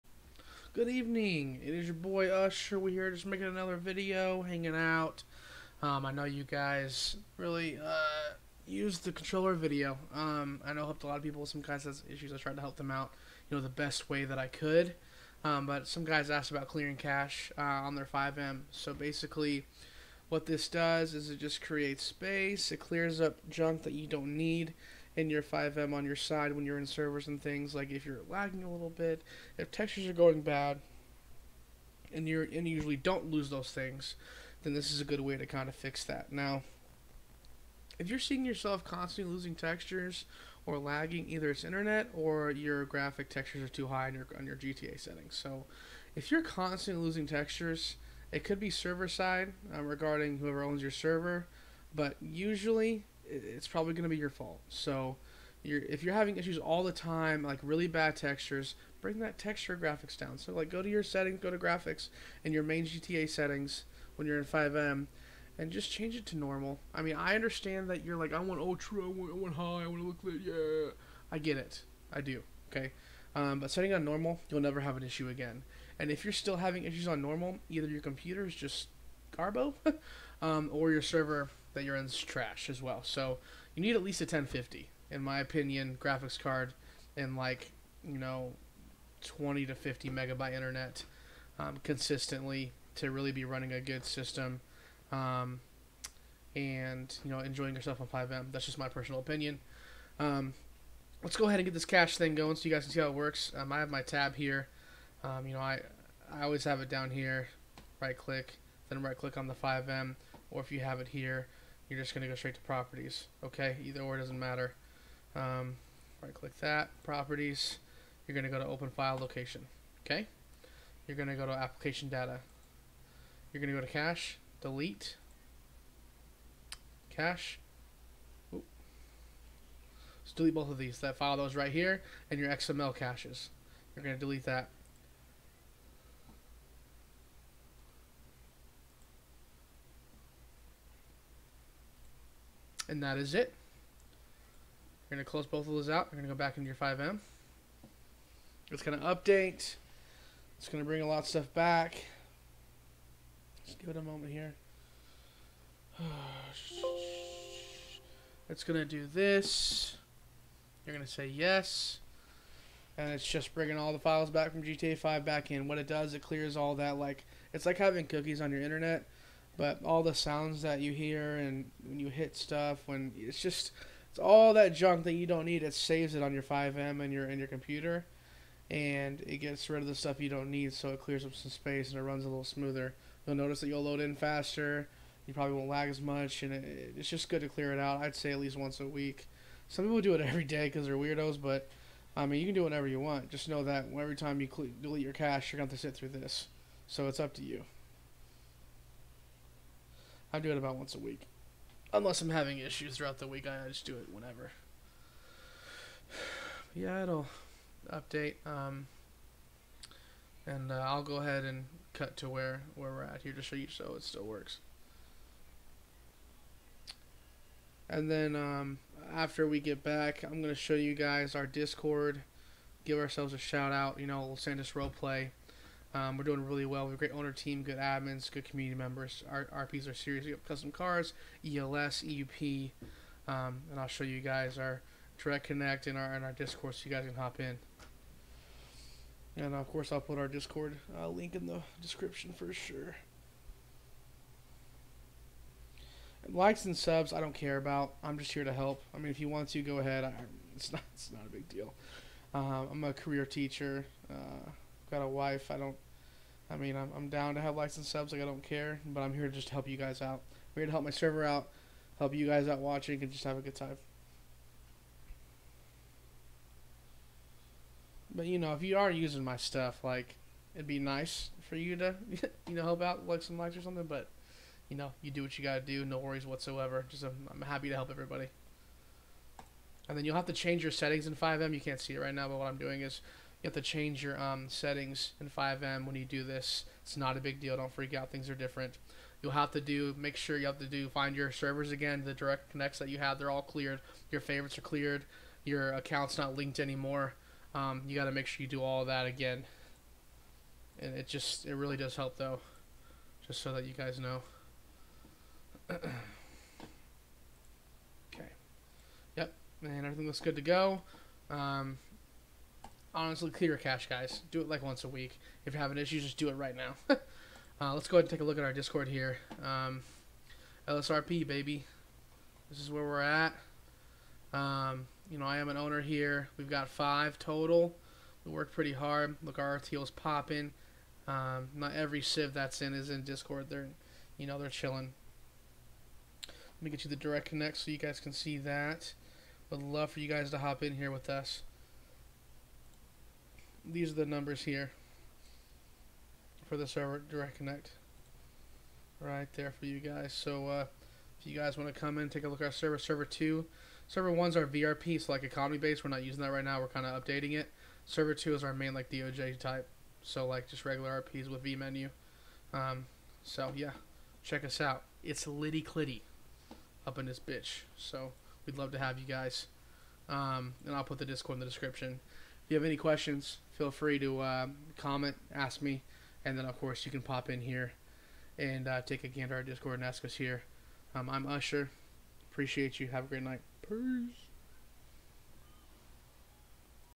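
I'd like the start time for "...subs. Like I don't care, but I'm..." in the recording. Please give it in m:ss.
4:17.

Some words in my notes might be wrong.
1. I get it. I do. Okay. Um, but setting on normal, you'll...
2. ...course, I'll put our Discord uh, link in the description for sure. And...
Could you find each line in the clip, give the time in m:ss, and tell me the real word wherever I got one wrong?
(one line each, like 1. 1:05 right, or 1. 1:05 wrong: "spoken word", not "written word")
1. 1:11 right
2. 3:59 right.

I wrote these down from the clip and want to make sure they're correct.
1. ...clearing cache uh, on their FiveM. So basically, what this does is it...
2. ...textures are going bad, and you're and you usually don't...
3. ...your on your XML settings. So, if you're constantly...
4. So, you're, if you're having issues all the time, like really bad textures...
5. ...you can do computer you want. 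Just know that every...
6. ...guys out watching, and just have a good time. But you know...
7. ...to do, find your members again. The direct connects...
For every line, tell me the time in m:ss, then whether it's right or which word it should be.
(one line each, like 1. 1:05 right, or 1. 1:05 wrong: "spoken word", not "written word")
1. 0:16 right
2. 0:29 right
3. 0:44 wrong: "GTA", not "XML"
4. 0:54 right
5. 3:12 wrong: "whatever", not "computer"
6. 4:22 right
7. 4:50 wrong: "servers", not "members".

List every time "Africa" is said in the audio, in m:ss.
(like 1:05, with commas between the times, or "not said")
not said.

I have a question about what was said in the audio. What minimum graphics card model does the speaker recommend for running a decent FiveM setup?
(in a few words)
1050.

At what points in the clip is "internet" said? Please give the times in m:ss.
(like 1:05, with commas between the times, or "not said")
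0:41, 1:30, 2:48.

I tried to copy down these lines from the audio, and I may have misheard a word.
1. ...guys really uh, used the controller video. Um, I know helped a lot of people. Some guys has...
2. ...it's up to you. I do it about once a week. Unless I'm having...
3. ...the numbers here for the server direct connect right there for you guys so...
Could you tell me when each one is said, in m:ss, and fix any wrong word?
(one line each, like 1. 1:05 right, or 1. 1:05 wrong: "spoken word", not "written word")
1. 0:06 right
2. 3:17 right
3. 5:43 right.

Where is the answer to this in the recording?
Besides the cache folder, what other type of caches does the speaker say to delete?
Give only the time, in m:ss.
2:12.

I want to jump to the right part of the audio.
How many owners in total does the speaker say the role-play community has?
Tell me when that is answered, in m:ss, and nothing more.
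5:26.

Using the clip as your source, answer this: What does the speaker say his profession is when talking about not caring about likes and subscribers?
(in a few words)
Teacher.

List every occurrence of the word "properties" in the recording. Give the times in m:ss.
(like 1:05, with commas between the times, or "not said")
1:52, 1:57.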